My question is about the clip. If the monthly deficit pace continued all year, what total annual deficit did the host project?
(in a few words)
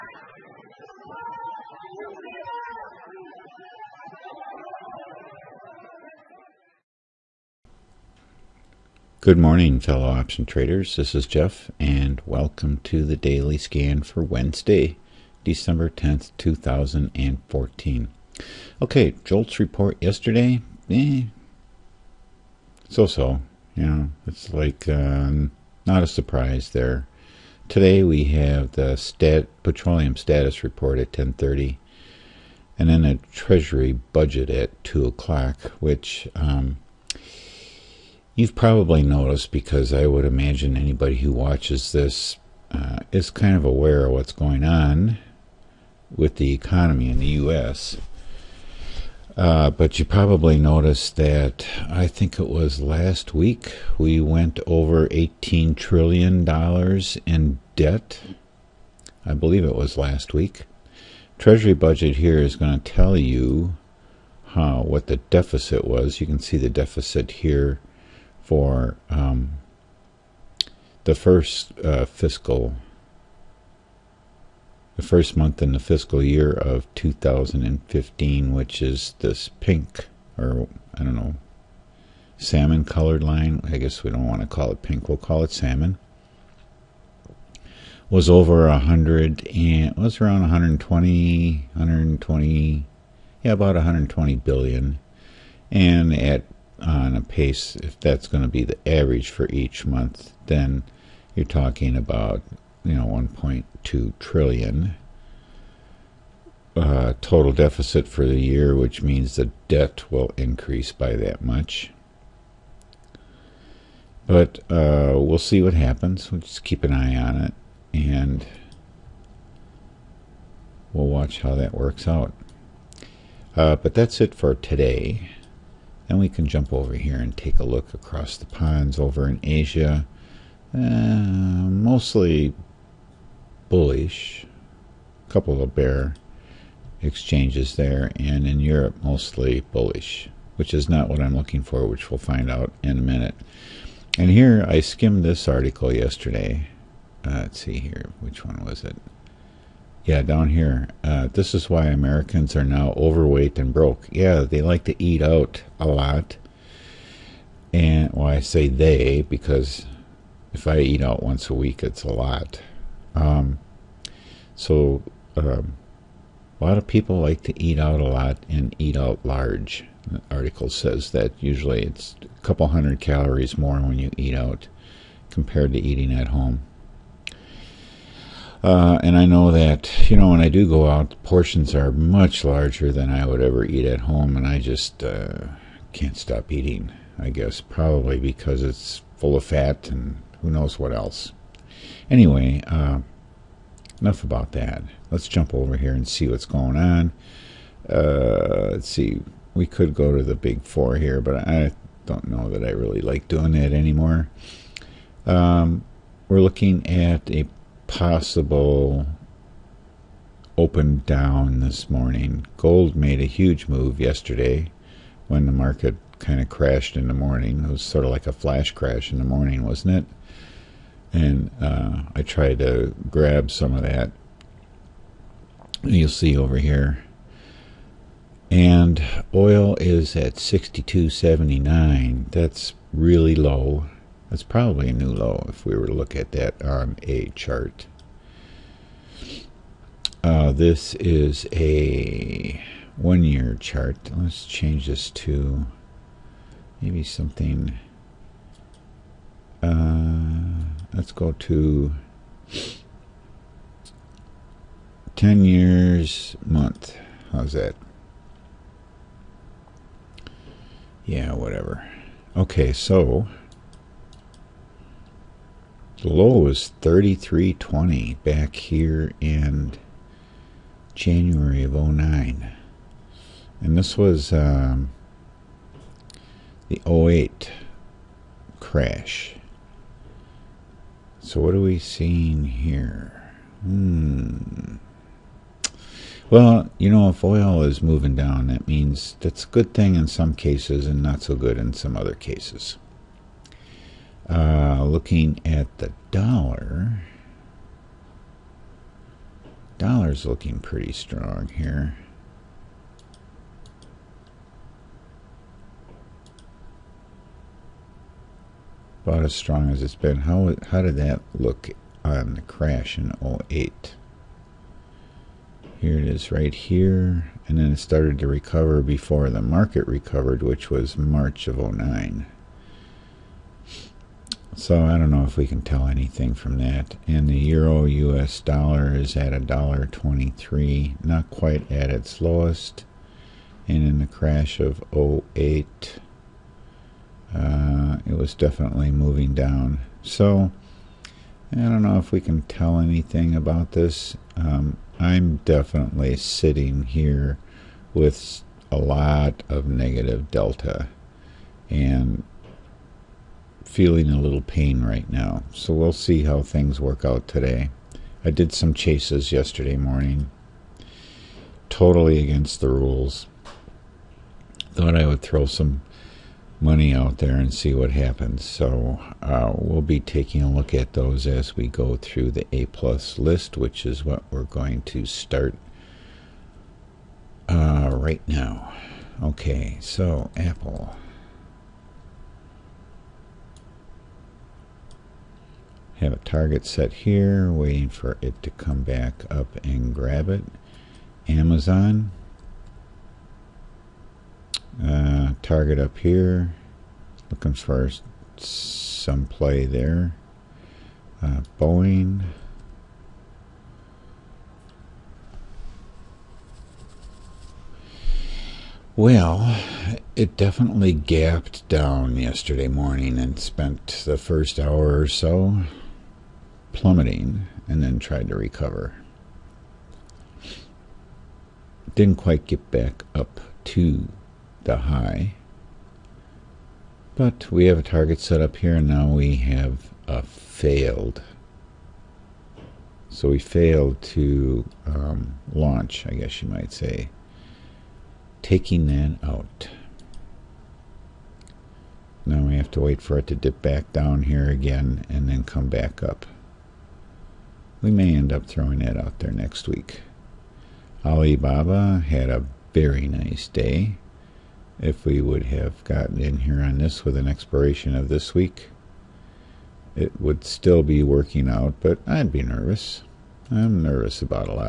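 1.2 trillion.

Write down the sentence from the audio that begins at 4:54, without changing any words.
Uh, looking at the dollar, dollar's looking pretty strong here.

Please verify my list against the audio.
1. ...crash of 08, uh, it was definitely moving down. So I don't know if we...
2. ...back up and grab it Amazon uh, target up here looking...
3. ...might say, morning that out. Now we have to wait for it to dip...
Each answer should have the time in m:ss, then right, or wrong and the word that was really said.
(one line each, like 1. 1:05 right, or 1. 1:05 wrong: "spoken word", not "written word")
1. 5:34 right
2. 6:28 right
3. 7:16 wrong: "taking", not "morning".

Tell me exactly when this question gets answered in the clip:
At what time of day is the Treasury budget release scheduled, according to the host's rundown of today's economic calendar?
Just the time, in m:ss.
0:34.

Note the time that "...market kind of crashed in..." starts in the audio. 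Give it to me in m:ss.
3:35.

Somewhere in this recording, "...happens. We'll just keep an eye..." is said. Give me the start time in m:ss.
1:55.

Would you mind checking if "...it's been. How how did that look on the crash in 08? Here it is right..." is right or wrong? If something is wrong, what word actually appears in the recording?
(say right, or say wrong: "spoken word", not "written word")
right.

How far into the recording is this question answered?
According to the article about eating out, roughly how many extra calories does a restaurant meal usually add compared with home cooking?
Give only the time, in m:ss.
2:52.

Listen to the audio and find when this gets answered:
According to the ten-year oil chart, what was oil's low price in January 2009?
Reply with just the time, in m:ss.
4:26.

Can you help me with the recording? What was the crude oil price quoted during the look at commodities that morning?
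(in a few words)
62.79.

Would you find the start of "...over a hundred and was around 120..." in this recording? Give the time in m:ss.
1:28.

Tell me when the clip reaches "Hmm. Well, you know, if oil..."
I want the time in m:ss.
4:43.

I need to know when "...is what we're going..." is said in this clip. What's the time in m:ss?
6:13.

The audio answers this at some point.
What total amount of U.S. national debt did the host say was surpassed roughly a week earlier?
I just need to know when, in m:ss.
0:55.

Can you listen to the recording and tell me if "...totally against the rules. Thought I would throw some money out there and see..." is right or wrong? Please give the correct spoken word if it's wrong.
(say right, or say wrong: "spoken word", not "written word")
right.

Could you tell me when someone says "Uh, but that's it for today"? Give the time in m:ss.
2:03.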